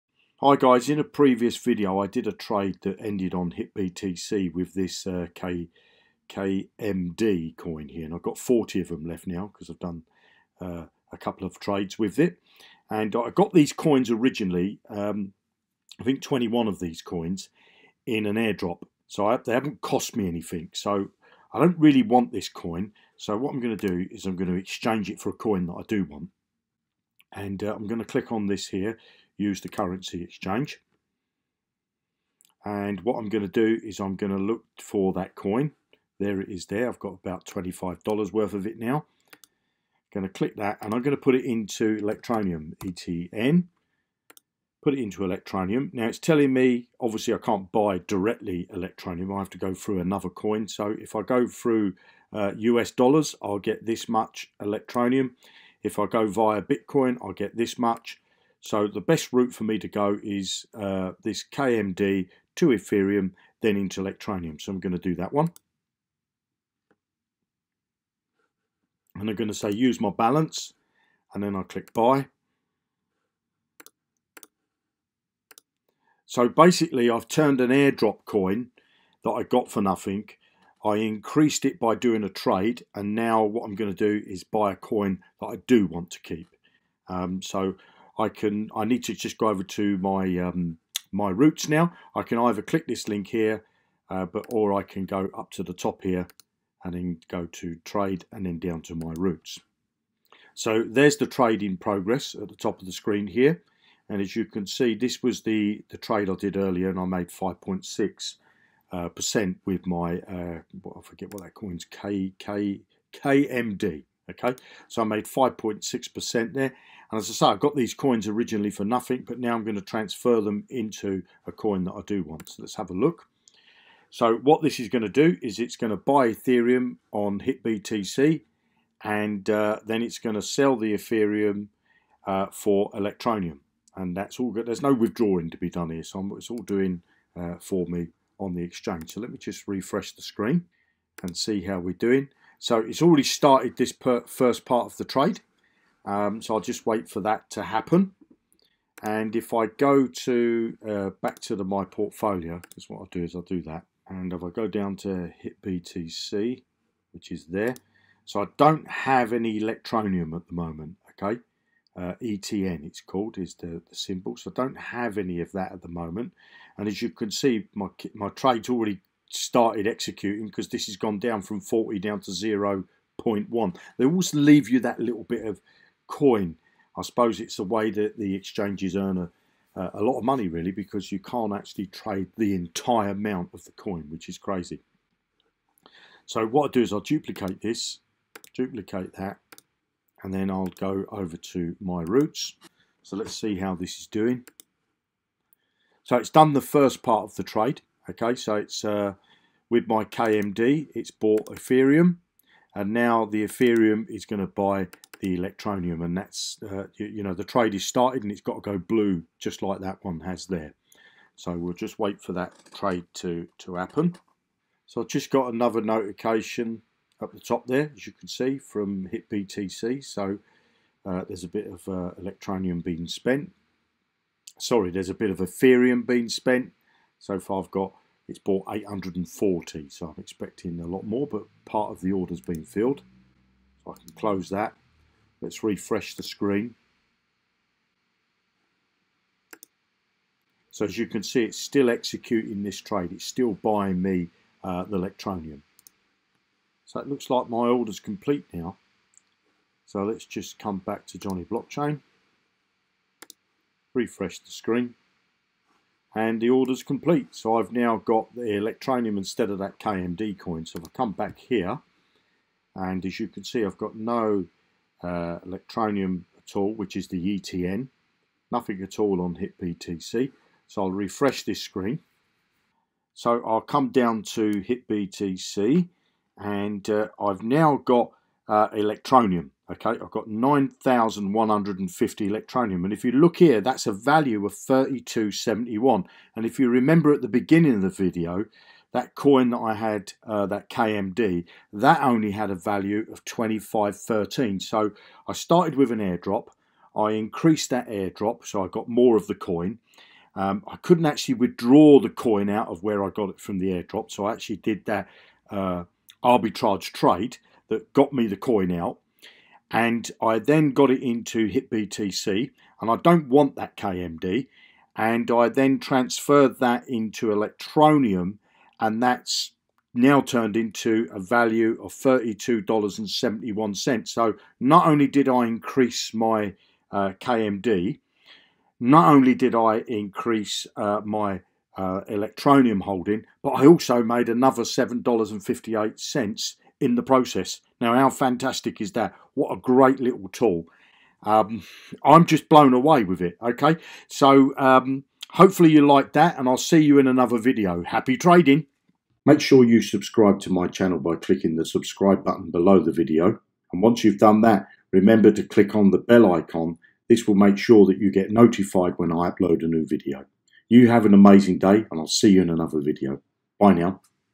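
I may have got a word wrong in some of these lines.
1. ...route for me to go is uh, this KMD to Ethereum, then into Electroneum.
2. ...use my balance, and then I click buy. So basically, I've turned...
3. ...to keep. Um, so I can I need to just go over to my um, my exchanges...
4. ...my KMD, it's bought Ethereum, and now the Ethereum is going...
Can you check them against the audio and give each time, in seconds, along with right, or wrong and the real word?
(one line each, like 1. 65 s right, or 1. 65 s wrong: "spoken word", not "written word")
1. 59 s right
2. 69 s right
3. 86 s wrong: "routes", not "exchanges"
4. 199 s right.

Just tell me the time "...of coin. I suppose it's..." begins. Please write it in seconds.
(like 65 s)
175 s.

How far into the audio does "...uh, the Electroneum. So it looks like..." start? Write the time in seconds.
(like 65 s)
244 s.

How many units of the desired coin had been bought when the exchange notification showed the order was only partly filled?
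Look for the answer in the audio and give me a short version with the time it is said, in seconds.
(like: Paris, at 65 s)
840, at 228 s.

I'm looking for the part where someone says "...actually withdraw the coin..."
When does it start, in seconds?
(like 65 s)
301 s.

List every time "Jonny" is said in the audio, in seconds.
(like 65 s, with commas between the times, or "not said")
251 s.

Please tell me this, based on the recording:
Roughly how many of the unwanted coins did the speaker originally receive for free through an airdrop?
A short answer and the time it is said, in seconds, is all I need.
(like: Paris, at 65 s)
21, at 16 s.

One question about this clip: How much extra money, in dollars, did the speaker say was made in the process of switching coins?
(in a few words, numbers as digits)
$7.58.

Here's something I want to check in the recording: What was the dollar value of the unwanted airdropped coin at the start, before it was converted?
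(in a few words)
$25.13.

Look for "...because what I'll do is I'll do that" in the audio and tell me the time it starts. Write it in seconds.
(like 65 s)
152 s.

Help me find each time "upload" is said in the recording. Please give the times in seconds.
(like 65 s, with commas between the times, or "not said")
359 s.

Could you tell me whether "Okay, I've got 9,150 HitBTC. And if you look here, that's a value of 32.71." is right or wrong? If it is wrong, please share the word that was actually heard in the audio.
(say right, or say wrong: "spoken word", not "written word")
wrong: "Electroneum", not "HitBTC".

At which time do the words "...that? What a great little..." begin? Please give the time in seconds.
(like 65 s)
338 s.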